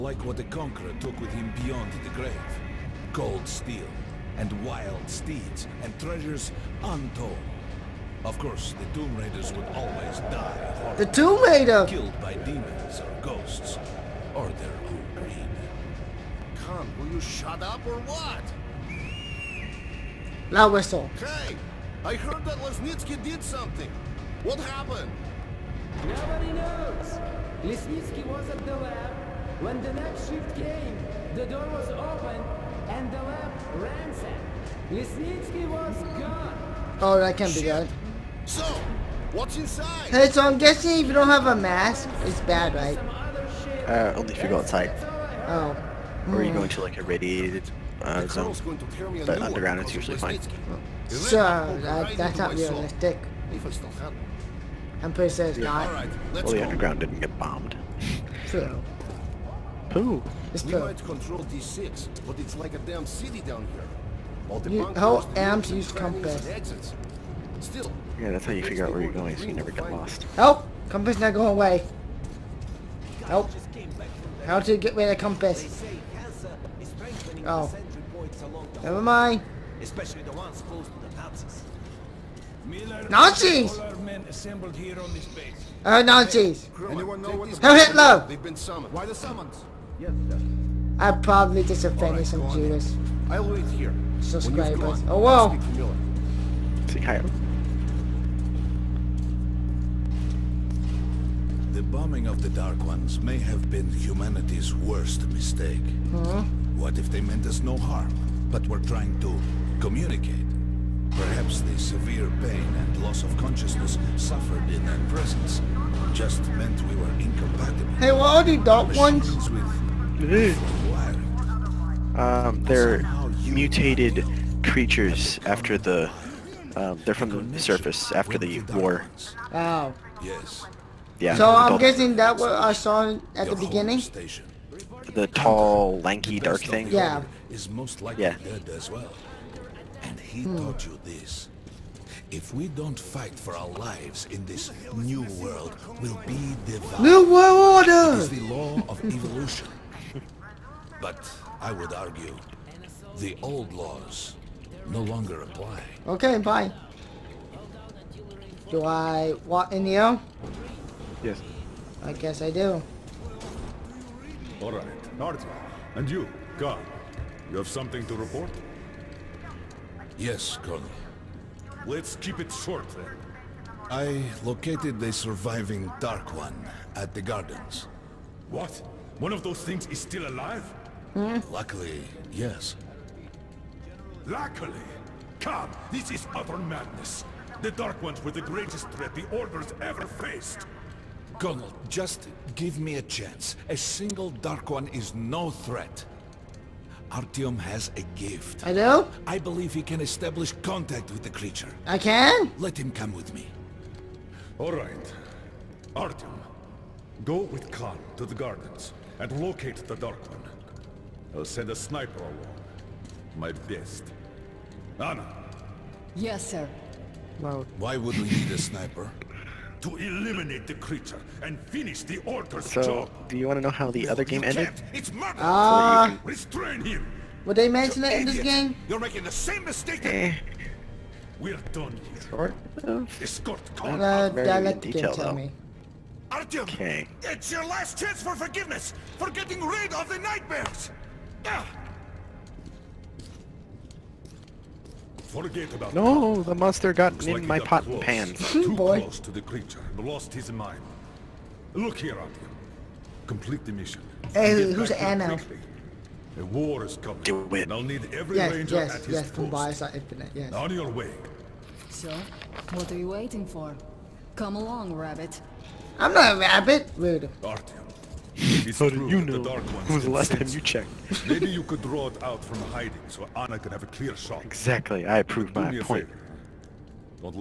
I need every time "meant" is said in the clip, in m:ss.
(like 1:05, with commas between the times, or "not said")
1:47, 1:56.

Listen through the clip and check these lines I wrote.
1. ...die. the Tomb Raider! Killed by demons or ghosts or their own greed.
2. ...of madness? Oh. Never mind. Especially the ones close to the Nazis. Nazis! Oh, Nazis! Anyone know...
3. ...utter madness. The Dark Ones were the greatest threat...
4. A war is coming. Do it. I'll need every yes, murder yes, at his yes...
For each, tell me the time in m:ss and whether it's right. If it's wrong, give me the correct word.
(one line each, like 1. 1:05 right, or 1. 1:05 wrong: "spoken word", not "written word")
1. 0:10 right
2. 1:15 wrong: "compass", not "madness"
3. 3:06 right
4. 4:16 wrong: "ranger", not "murder".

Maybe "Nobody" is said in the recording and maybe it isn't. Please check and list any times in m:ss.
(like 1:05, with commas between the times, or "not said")
0:26.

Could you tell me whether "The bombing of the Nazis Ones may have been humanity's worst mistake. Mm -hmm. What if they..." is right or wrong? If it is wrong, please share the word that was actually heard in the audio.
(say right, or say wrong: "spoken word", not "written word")
wrong: "Dark", not "Nazis".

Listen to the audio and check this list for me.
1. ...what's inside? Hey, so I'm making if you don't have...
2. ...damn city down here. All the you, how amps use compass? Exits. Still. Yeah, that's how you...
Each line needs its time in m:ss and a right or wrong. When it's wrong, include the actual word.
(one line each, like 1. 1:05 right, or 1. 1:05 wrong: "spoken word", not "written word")
1. 0:39 wrong: "guessing", not "making"
2. 1:02 right.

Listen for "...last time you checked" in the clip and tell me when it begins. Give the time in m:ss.
4:30.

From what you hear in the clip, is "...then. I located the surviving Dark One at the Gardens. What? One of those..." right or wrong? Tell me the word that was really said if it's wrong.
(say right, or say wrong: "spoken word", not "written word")
right.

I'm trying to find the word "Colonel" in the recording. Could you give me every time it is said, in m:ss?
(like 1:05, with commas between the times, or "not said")
2:50, 3:11.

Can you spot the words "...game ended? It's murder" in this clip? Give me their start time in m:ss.
3:44.